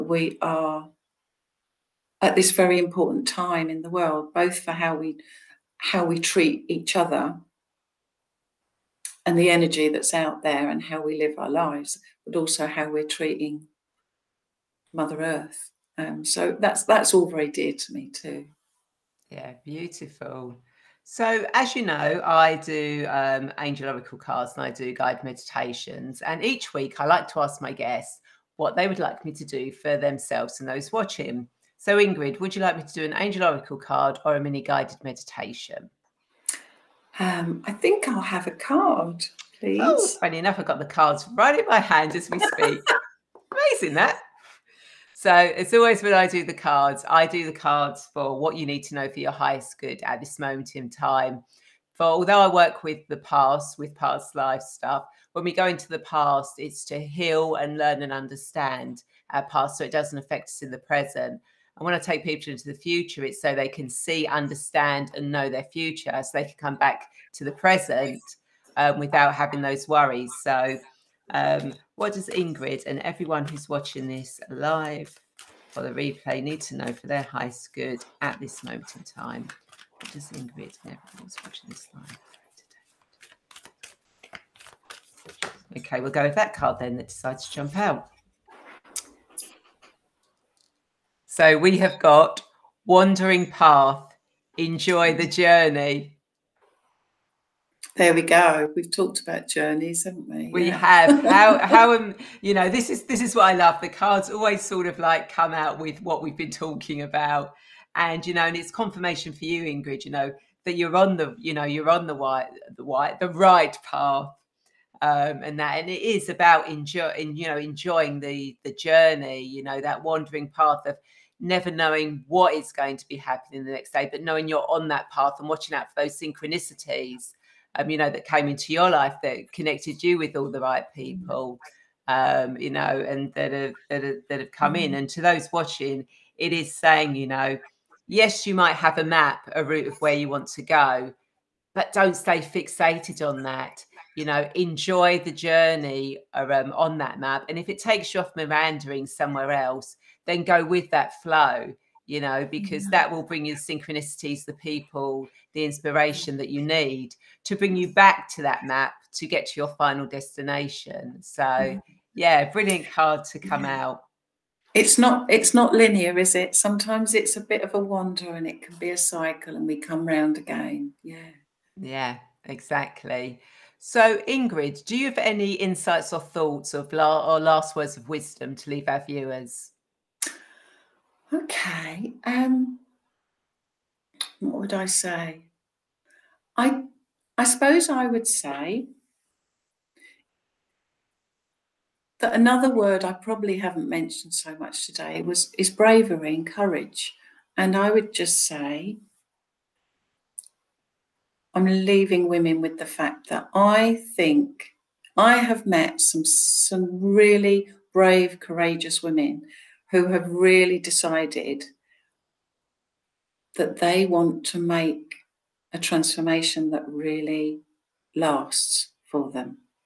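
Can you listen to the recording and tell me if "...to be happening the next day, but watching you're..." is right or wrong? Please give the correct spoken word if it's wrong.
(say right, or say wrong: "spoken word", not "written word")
wrong: "knowing", not "watching".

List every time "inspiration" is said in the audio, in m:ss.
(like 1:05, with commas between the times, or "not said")
2:35.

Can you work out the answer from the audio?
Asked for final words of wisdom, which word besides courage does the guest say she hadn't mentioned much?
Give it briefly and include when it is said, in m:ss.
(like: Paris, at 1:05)
bravery, at 3:15.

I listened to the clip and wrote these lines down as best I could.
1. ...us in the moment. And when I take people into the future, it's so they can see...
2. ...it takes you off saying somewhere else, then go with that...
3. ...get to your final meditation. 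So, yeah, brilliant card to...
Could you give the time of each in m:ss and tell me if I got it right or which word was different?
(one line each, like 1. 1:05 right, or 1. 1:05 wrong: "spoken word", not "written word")
1. 1:00 wrong: "present", not "moment"
2. 2:27 wrong: "meandering", not "saying"
3. 2:39 wrong: "destination", not "meditation".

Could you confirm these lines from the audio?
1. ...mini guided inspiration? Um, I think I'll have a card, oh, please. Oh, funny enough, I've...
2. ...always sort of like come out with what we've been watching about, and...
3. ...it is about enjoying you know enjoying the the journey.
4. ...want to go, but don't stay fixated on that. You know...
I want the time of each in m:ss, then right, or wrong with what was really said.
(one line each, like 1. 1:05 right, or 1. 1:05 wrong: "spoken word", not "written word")
1. 0:34 wrong: "meditation", not "inspiration"
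2. 1:44 wrong: "talking", not "watching"
3. 1:55 right
4. 2:20 right.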